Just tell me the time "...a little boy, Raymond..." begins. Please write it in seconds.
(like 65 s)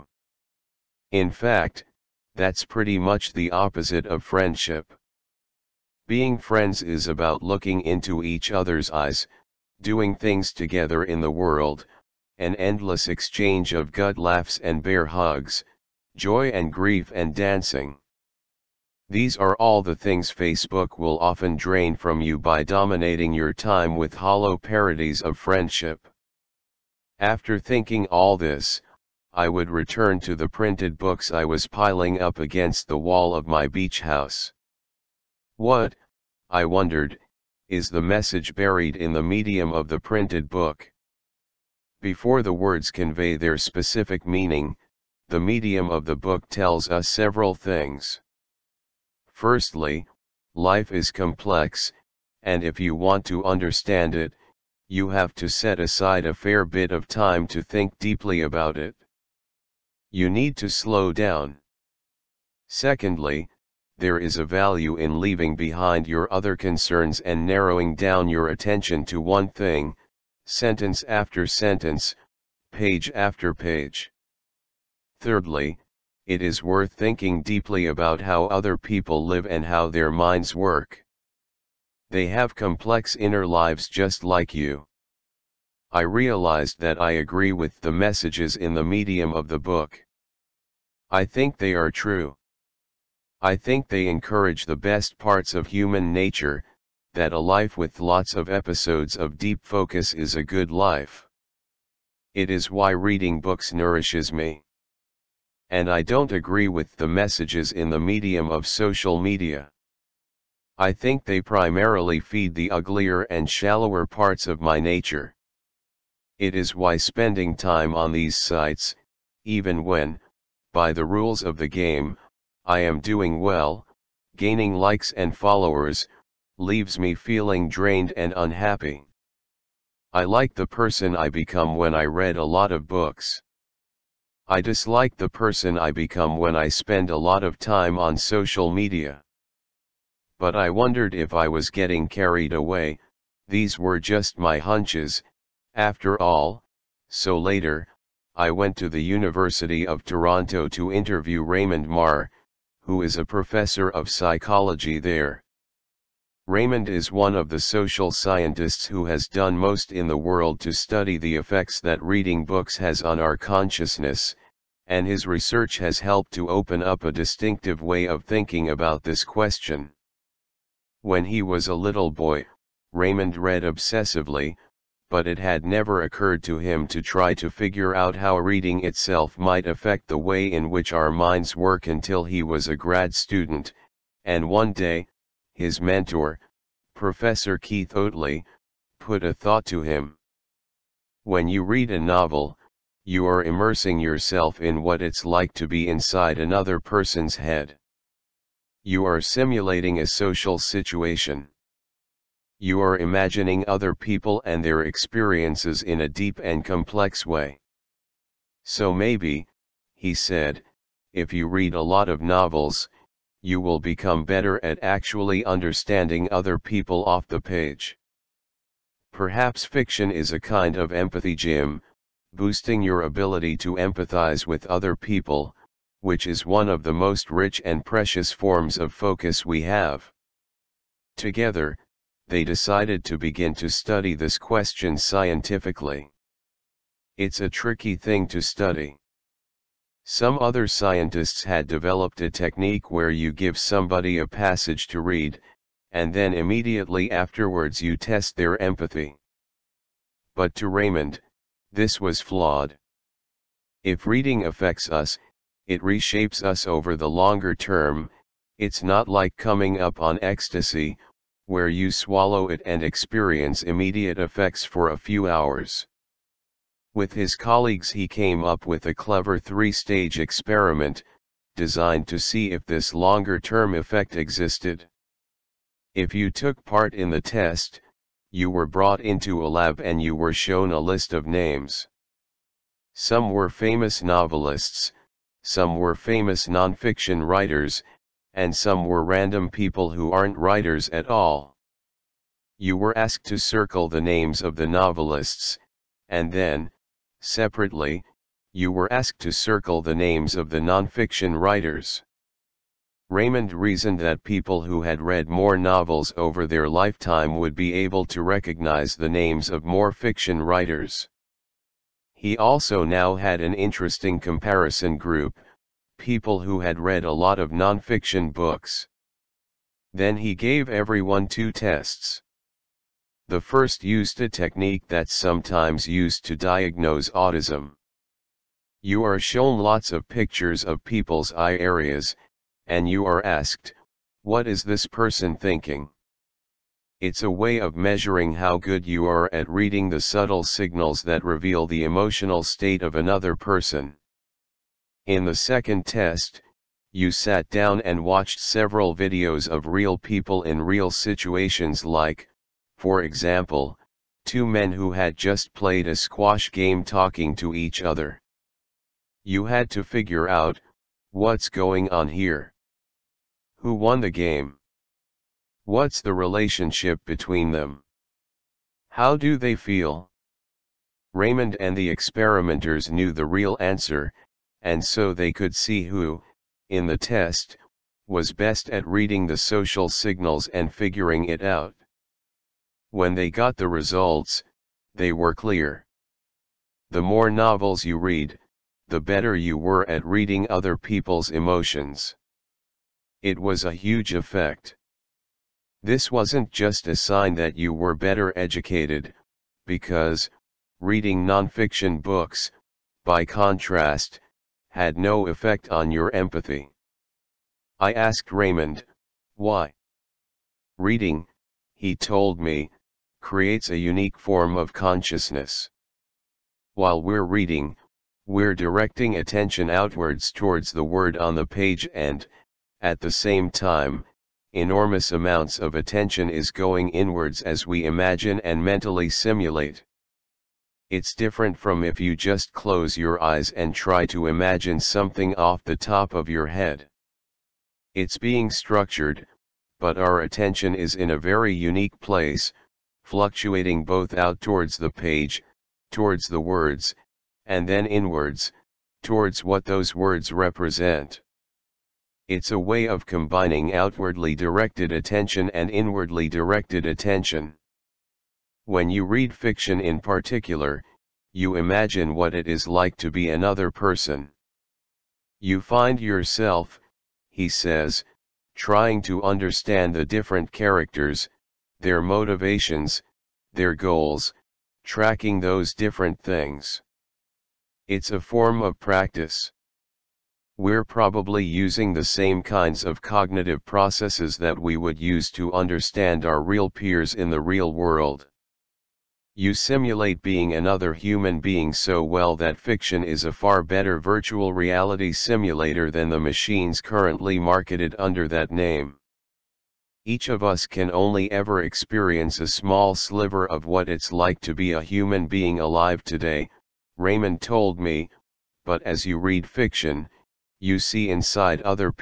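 171 s.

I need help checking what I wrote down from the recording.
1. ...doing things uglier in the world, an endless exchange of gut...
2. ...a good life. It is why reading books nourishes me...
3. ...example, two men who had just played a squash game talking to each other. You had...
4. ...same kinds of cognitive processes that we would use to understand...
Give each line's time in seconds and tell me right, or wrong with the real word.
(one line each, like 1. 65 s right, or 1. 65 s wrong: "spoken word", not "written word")
1. 9 s wrong: "together", not "uglier"
2. 100 s right
3. 353 s right
4. 482 s right.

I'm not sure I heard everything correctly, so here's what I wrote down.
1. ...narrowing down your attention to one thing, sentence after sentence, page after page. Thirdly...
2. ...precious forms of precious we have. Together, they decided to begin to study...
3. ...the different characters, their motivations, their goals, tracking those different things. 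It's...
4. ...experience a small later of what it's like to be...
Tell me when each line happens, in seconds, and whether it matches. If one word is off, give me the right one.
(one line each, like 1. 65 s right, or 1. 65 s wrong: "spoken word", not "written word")
1. 67 s right
2. 227 s wrong: "focus", not "precious"
3. 469 s right
4. 501 s wrong: "sliver", not "later".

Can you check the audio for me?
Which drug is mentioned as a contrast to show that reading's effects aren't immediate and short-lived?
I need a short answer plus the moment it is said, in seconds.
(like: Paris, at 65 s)
ecstasy, at 260 s.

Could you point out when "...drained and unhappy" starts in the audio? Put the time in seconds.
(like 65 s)
127 s.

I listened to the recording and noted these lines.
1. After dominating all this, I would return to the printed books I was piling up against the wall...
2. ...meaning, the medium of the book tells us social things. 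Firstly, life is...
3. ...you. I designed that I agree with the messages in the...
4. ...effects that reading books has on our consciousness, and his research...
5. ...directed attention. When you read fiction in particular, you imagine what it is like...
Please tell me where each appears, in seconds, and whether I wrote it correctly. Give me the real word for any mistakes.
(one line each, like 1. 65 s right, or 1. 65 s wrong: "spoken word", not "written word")
1. 27 s wrong: "thinking", not "dominating"
2. 44 s wrong: "several", not "social"
3. 84 s wrong: "realized", not "designed"
4. 161 s right
5. 456 s right.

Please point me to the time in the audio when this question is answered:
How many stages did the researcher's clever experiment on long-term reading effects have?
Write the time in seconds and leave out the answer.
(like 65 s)
269 s.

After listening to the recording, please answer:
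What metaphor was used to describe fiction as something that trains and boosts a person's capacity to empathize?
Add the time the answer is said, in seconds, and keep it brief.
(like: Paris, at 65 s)
empathy gym, at 220 s.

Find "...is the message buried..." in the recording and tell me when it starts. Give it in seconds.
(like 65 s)
37 s.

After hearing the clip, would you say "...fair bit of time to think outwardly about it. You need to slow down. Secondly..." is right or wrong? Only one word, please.
wrong.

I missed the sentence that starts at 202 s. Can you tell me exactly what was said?
You are imagining other people and their experiences in a deep and complex way.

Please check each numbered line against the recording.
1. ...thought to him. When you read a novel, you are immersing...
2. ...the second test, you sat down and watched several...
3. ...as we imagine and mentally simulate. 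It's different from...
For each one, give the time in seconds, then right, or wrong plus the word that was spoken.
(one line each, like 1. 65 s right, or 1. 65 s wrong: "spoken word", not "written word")
1. 189 s right
2. 345 s right
3. 427 s right.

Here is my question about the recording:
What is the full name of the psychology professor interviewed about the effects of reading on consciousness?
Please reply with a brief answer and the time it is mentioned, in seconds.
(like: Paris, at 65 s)
Raymond Mar, at 151 s.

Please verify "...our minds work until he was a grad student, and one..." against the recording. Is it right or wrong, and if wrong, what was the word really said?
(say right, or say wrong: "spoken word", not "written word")
right.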